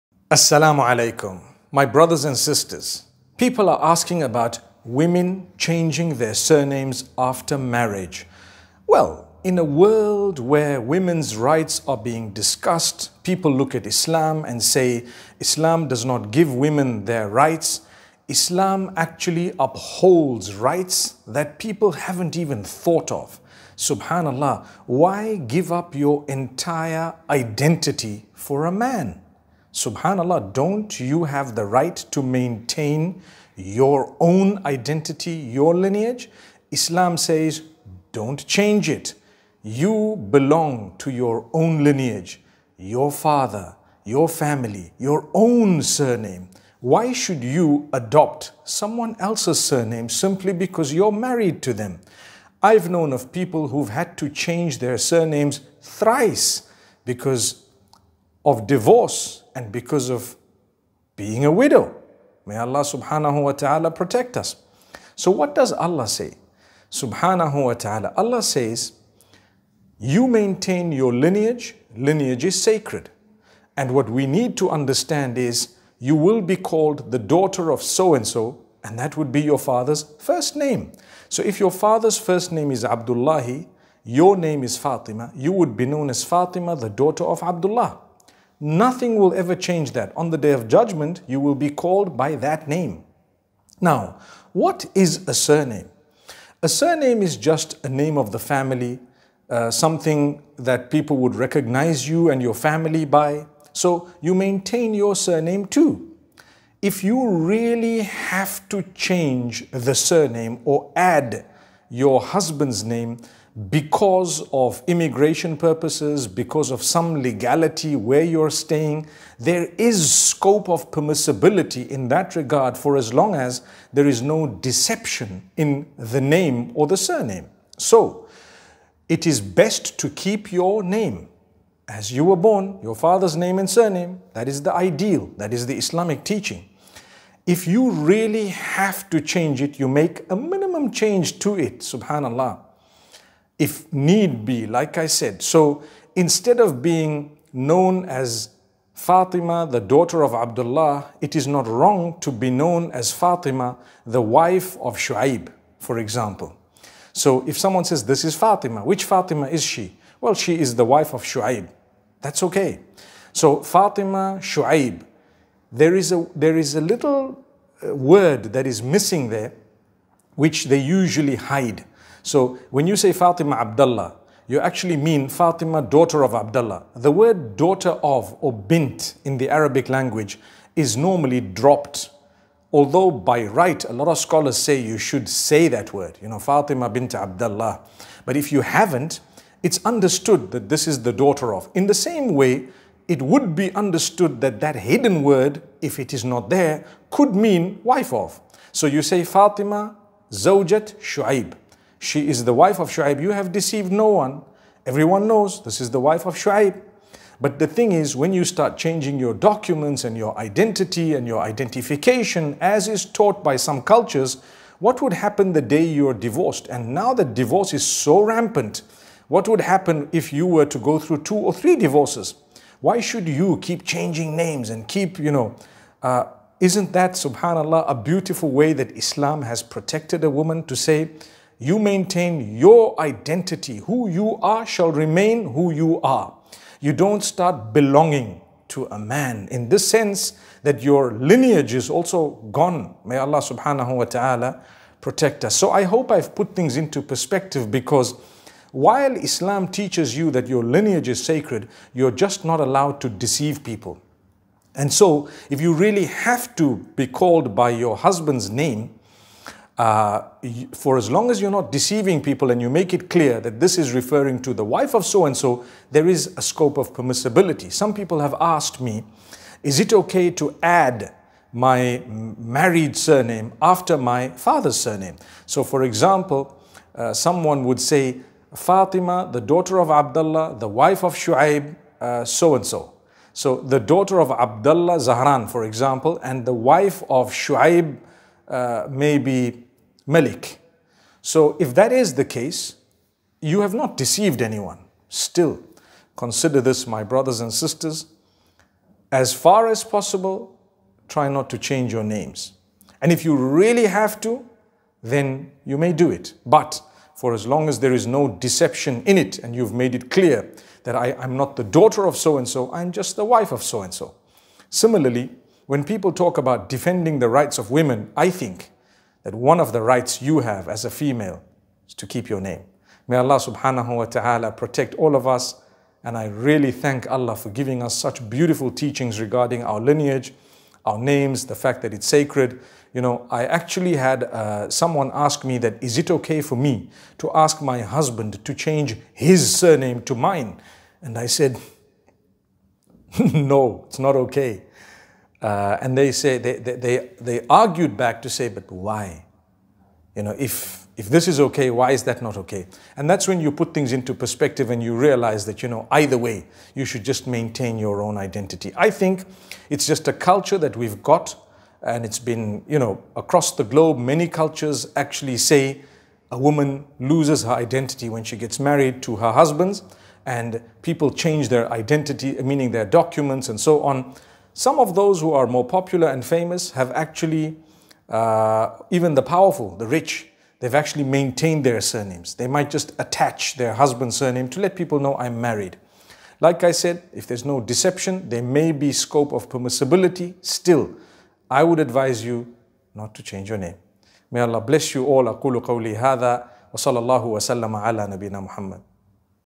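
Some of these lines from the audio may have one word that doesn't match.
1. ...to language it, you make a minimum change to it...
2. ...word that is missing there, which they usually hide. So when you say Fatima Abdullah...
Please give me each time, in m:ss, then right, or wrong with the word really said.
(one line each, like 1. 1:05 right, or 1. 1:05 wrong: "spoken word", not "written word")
1. 2:19 wrong: "change", not "language"
2. 2:47 right.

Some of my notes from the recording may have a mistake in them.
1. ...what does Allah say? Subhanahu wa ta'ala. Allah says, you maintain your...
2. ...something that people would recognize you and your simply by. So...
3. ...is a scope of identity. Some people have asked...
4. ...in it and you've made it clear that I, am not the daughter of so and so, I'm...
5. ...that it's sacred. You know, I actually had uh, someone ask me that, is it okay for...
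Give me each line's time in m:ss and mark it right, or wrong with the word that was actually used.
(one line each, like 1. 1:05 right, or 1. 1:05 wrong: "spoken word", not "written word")
1. 1:05 right
2. 1:39 wrong: "family", not "simply"
3. 4:26 wrong: "permissibility", not "identity"
4. 5:09 right
5. 5:31 right.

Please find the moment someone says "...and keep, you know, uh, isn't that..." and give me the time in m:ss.
3:44.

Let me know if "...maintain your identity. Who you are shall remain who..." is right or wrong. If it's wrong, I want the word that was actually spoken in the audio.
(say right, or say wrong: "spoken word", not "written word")
right.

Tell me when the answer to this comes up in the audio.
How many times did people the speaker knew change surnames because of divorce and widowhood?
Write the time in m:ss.
0:55.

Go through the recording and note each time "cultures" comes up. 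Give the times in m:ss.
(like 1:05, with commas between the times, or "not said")
3:33, 6:00, 6:04.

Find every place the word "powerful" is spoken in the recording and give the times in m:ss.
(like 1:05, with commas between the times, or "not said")
6:19.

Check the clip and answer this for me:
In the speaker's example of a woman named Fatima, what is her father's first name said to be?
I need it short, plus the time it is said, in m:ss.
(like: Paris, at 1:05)
Abdullahi, at 1:22.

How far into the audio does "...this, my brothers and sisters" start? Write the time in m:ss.
4:56.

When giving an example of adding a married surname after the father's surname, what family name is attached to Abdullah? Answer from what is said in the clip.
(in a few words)
Zahran.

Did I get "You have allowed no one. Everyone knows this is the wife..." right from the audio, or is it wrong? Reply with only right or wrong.
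wrong.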